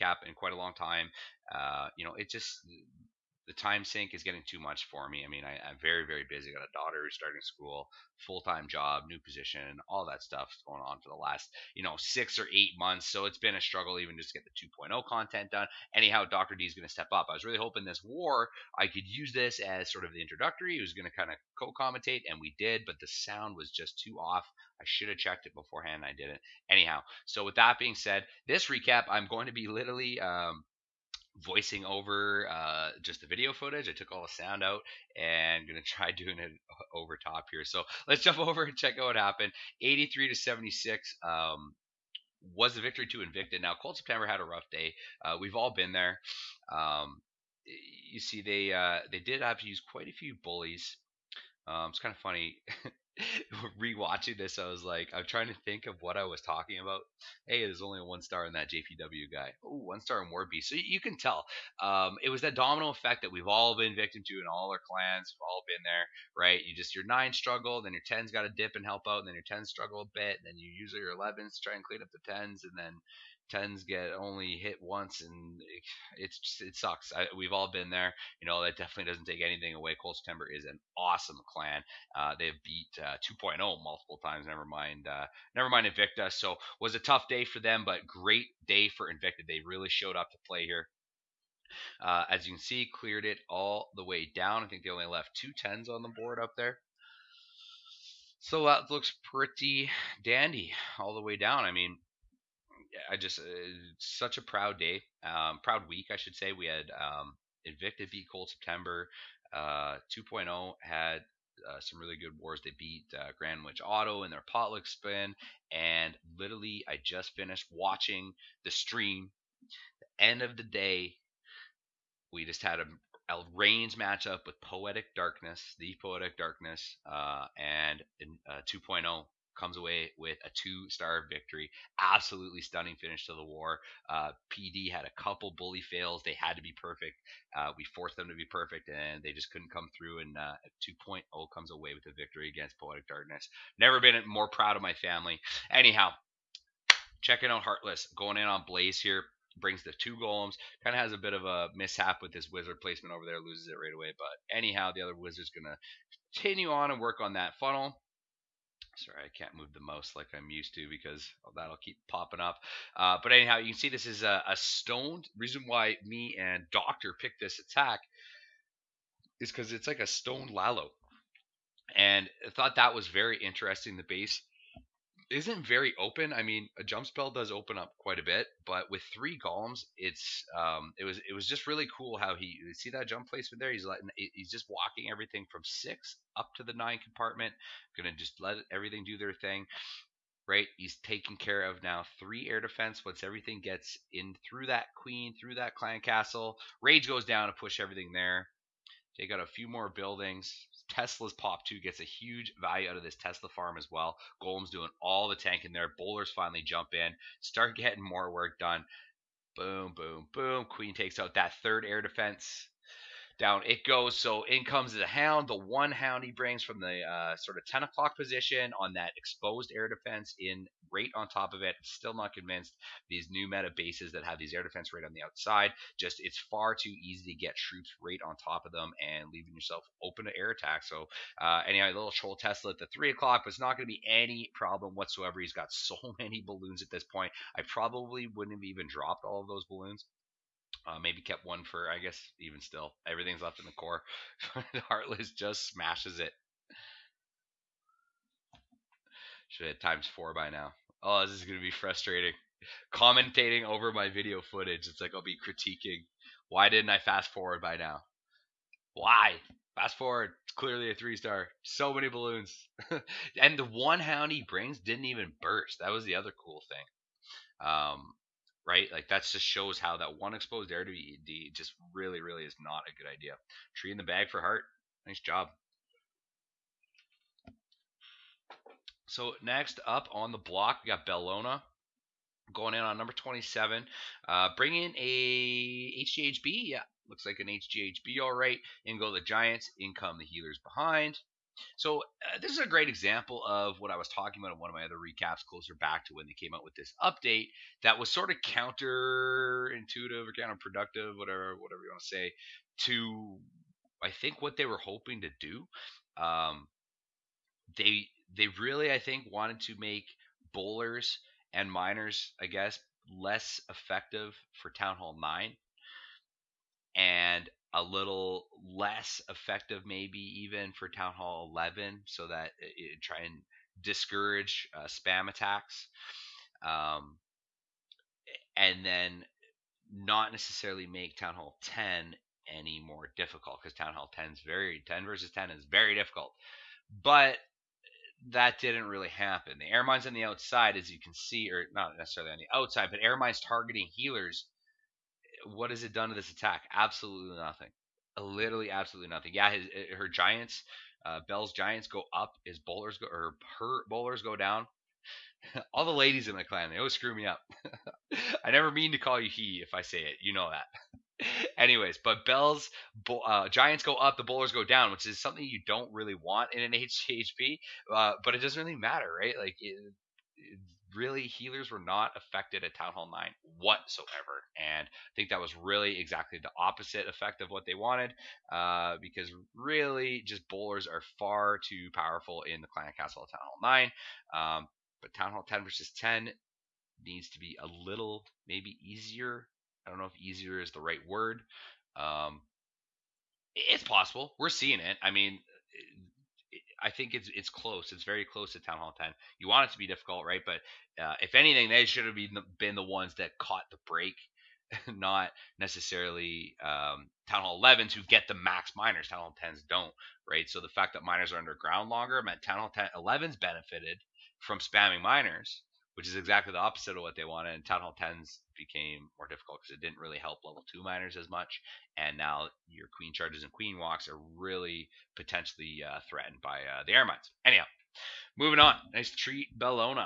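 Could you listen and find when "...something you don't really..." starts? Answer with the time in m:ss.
6:05.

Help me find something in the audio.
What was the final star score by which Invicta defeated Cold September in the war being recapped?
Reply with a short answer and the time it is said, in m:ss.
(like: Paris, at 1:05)
83 to 76, at 0:39.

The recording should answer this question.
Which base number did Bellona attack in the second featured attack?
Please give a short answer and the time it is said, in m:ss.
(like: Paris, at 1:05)
27, at 4:43.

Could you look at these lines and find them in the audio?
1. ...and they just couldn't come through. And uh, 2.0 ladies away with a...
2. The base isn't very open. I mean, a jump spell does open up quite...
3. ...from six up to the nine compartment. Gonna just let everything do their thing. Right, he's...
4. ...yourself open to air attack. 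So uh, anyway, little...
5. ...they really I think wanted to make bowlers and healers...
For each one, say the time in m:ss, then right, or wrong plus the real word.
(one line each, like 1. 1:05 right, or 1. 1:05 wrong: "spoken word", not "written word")
1. 2:18 wrong: "comes", not "ladies"
2. 2:53 right
3. 3:05 right
4. 3:49 right
5. 5:08 wrong: "miners", not "healers".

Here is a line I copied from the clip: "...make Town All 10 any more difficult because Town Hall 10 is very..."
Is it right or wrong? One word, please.
wrong.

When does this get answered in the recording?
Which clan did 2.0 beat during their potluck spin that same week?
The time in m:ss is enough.
1:53.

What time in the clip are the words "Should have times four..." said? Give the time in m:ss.
4:09.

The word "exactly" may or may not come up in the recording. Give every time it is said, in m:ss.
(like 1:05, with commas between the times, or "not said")
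6:15, 6:56.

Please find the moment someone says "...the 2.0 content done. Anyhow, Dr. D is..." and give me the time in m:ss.
0:14.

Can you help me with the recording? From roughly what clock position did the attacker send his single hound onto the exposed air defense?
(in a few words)
10 o'clock.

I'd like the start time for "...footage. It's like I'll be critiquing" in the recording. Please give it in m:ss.
4:14.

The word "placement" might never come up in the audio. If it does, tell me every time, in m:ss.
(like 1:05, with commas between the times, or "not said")
2:32, 3:03.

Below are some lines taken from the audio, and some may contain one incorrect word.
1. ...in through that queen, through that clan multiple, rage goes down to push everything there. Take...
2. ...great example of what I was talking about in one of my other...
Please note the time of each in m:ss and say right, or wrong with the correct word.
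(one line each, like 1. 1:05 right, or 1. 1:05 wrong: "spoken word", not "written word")
1. 3:14 wrong: "castle", not "multiple"
2. 4:52 right.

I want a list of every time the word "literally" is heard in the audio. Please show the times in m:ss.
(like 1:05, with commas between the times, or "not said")
0:29, 1:56, 5:48.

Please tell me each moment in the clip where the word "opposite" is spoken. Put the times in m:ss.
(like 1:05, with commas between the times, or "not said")
6:16, 6:56.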